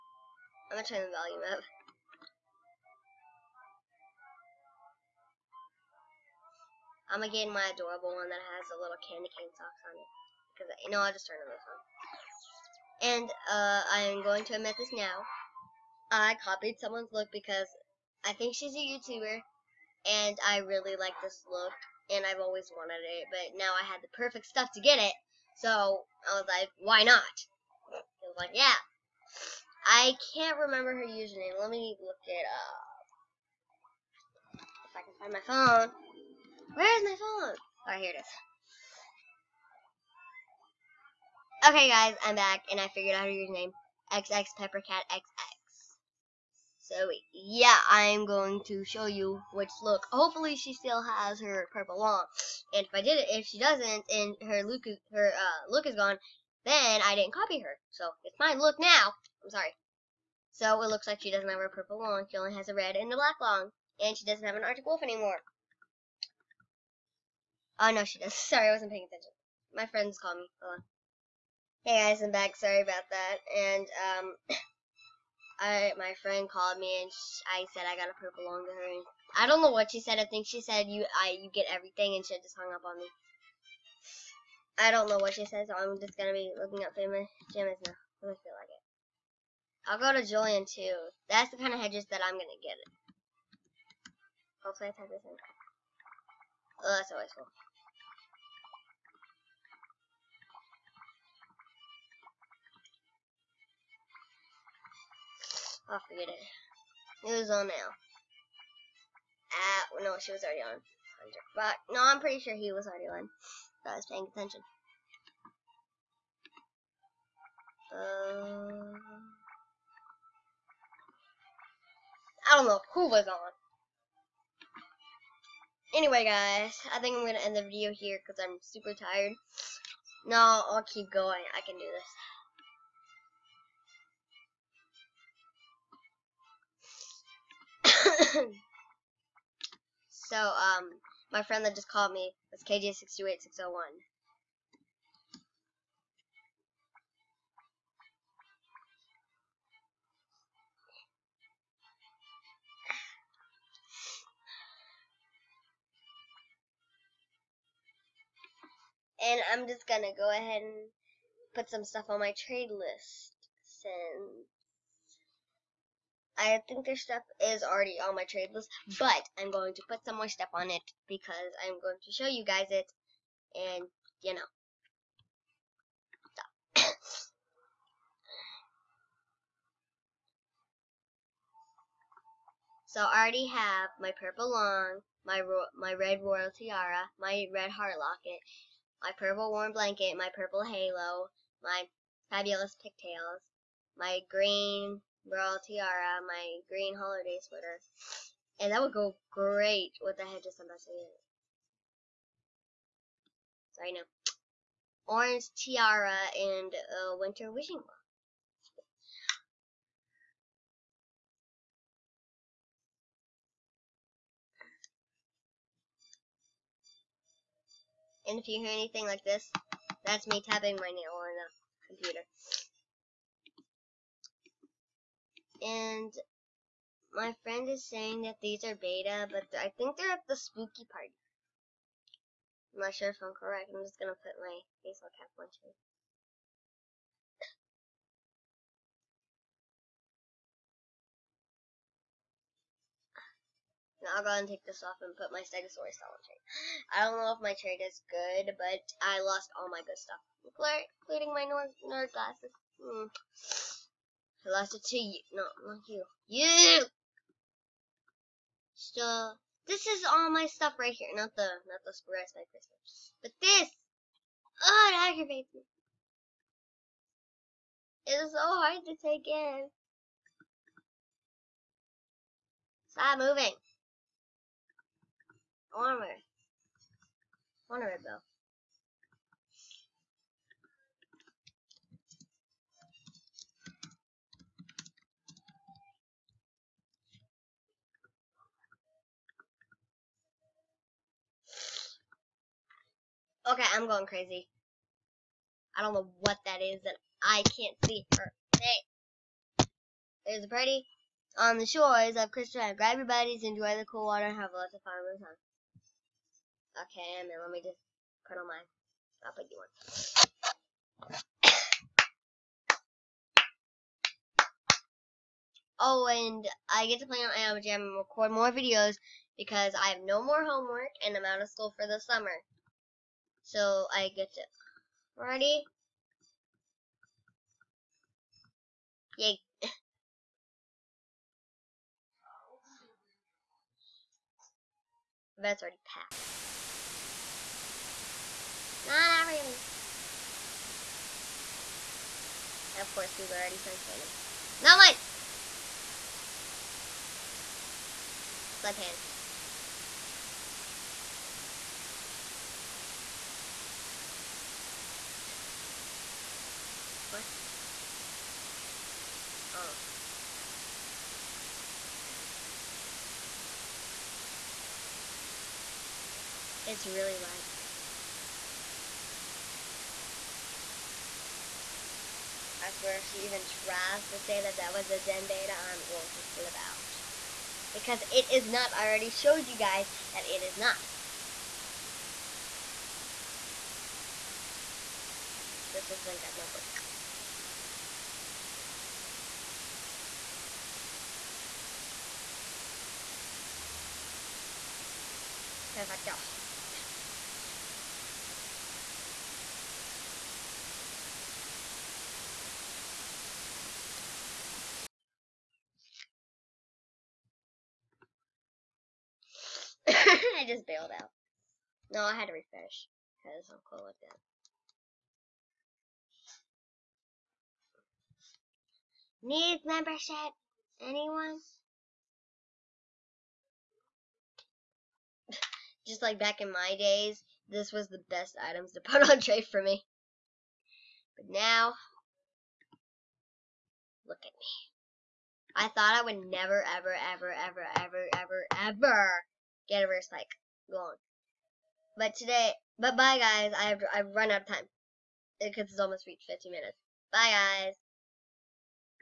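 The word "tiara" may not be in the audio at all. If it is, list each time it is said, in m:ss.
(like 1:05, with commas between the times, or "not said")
3:06, 3:15, 3:25.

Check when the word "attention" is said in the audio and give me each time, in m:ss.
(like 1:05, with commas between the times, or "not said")
1:09, 1:54.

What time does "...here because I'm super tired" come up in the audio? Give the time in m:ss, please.
2:07.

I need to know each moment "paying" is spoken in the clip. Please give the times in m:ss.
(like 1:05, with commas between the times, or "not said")
1:08, 1:54.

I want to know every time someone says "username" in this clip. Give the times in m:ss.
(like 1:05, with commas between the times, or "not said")
0:31, 0:43.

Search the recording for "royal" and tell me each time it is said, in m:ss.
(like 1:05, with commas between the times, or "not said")
3:06, 3:15.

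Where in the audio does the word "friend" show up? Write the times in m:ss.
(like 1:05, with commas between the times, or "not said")
1:09, 1:16, 2:21, 3:47.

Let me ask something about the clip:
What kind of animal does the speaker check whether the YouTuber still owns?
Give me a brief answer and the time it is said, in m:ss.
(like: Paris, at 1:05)
Arctic wolf, at 1:04.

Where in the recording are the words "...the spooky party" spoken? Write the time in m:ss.
3:50.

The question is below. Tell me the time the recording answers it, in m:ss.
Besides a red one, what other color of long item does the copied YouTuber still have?
1:03.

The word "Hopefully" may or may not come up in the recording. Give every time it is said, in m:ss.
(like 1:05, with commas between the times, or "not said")
0:50, 1:34.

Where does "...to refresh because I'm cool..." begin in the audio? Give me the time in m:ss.
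6:52.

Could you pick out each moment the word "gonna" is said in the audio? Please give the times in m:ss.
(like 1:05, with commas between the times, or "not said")
0:00, 0:07, 1:26, 1:32, 2:39, 3:53, 6:26.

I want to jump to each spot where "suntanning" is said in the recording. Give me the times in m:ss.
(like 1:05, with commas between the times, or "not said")
5:43, 5:48.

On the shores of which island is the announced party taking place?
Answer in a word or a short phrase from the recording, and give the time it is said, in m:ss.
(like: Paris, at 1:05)
Crystal Island, at 5:02.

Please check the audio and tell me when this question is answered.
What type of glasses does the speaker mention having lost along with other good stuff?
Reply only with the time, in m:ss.
4:11.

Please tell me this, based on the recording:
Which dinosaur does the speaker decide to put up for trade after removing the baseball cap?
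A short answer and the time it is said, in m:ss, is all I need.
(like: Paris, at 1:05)
Stegosaurus, at 4:05.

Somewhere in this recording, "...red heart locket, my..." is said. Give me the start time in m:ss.
3:07.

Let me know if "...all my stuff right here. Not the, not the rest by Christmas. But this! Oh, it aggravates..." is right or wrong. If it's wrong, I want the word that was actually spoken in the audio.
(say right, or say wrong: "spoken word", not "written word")
right.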